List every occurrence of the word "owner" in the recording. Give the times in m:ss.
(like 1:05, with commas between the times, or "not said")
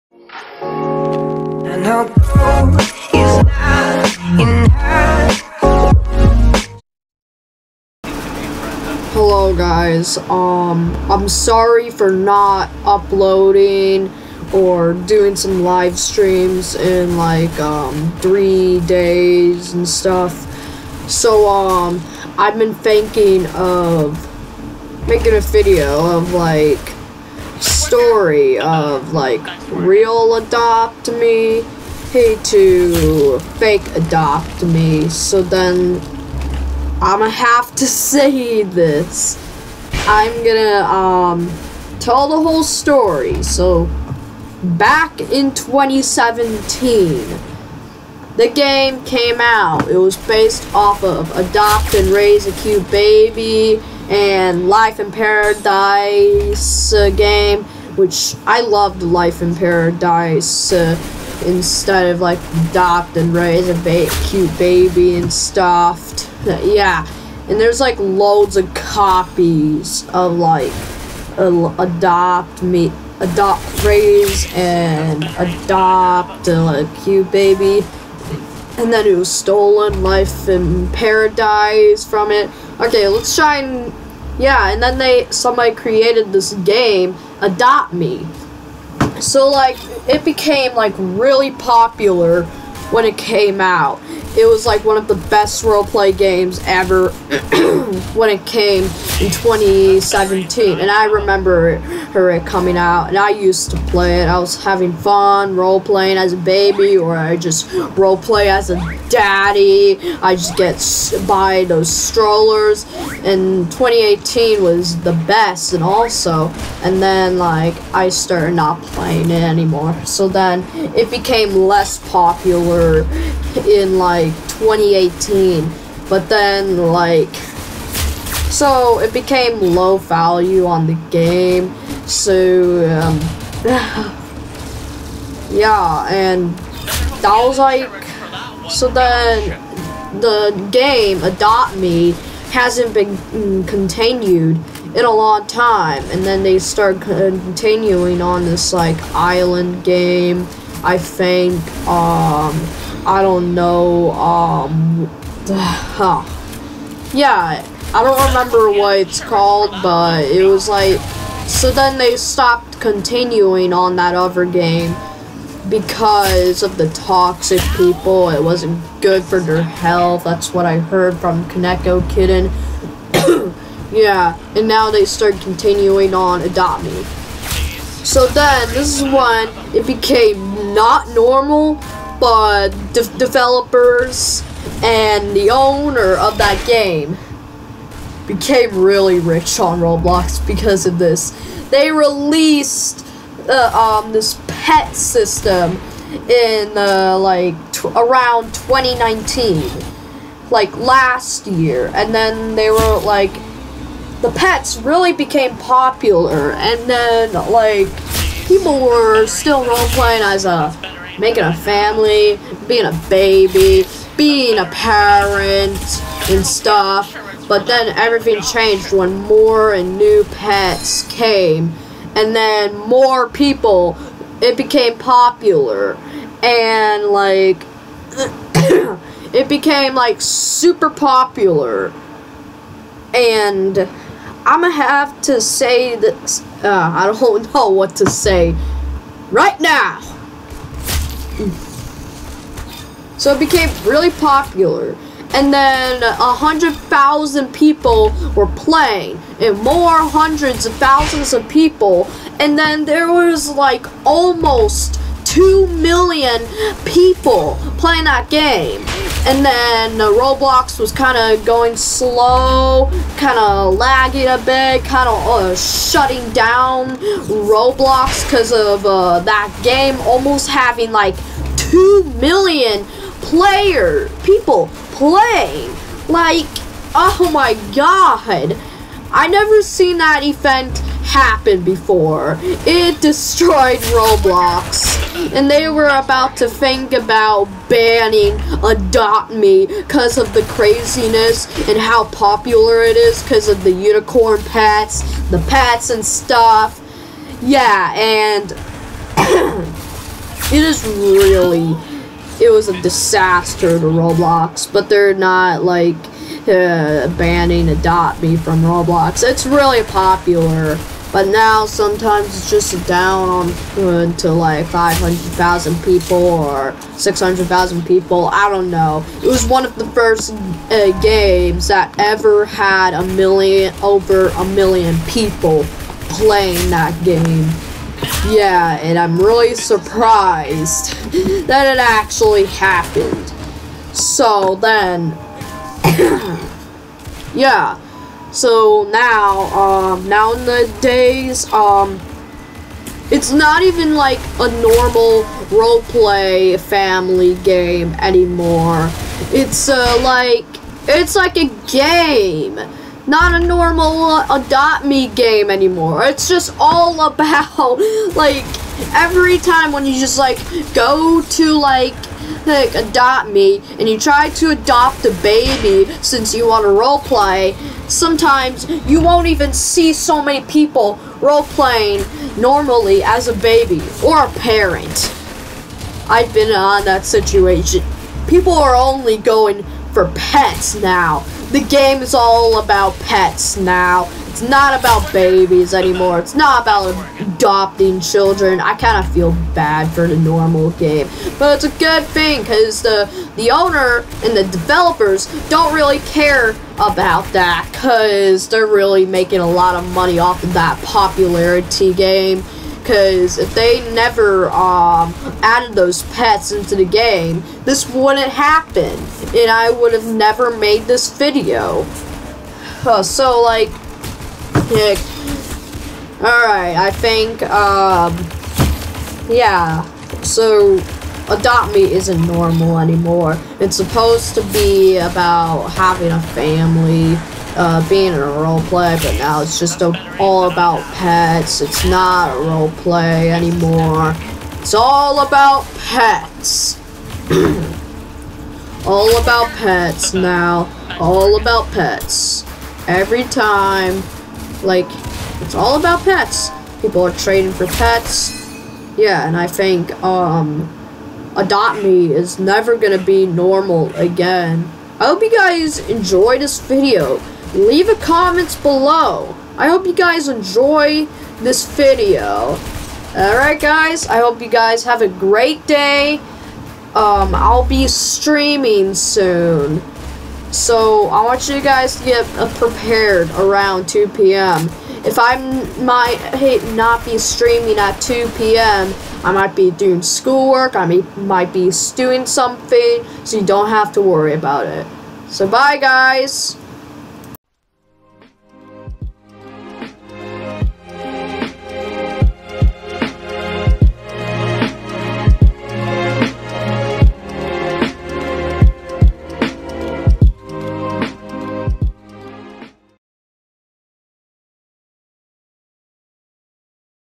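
3:05, 6:33.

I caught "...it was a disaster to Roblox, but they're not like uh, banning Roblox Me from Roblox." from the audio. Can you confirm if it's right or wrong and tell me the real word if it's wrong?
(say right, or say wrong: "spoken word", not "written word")
wrong: "Adopt", not "Roblox".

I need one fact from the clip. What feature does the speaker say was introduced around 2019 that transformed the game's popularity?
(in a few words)
pet system.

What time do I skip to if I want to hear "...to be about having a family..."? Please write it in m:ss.
7:04.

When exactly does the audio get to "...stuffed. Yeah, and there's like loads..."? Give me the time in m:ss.
1:05.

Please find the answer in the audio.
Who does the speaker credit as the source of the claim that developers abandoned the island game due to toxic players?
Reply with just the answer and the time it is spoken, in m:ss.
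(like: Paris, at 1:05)
Kaneko Kitten, at 2:51.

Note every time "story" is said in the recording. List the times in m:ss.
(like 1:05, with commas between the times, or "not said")
0:27, 0:42.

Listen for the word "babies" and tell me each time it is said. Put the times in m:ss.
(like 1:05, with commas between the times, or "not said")
6:25.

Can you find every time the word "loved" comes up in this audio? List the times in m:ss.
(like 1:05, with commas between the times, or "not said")
0:58.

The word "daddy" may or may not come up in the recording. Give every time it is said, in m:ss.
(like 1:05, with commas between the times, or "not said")
1:49.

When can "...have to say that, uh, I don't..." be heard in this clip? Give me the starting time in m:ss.
3:54.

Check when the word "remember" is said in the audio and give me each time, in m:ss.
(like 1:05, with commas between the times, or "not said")
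1:41, 2:38.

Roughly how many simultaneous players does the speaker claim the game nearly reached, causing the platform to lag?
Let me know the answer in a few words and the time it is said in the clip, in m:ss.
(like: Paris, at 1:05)
2 million, at 4:15.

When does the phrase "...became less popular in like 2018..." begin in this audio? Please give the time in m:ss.
2:01.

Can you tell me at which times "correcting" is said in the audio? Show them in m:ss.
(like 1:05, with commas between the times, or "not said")
not said.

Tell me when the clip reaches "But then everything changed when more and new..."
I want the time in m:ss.
3:37.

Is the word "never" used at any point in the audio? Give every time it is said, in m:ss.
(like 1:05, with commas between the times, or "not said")
4:39, 6:43, 6:50, 7:32.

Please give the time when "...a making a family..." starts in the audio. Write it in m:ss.
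3:30.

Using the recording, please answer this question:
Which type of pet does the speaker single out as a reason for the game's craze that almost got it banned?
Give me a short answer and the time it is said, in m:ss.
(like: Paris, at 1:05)
unicorn, at 4:53.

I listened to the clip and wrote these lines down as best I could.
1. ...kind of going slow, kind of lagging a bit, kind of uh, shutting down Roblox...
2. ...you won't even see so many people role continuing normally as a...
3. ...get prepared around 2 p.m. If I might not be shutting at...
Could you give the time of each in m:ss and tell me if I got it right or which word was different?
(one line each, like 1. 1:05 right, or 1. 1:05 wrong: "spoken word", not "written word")
1. 4:20 right
2. 6:08 wrong: "playing", not "continuing"
3. 7:52 wrong: "streaming", not "shutting".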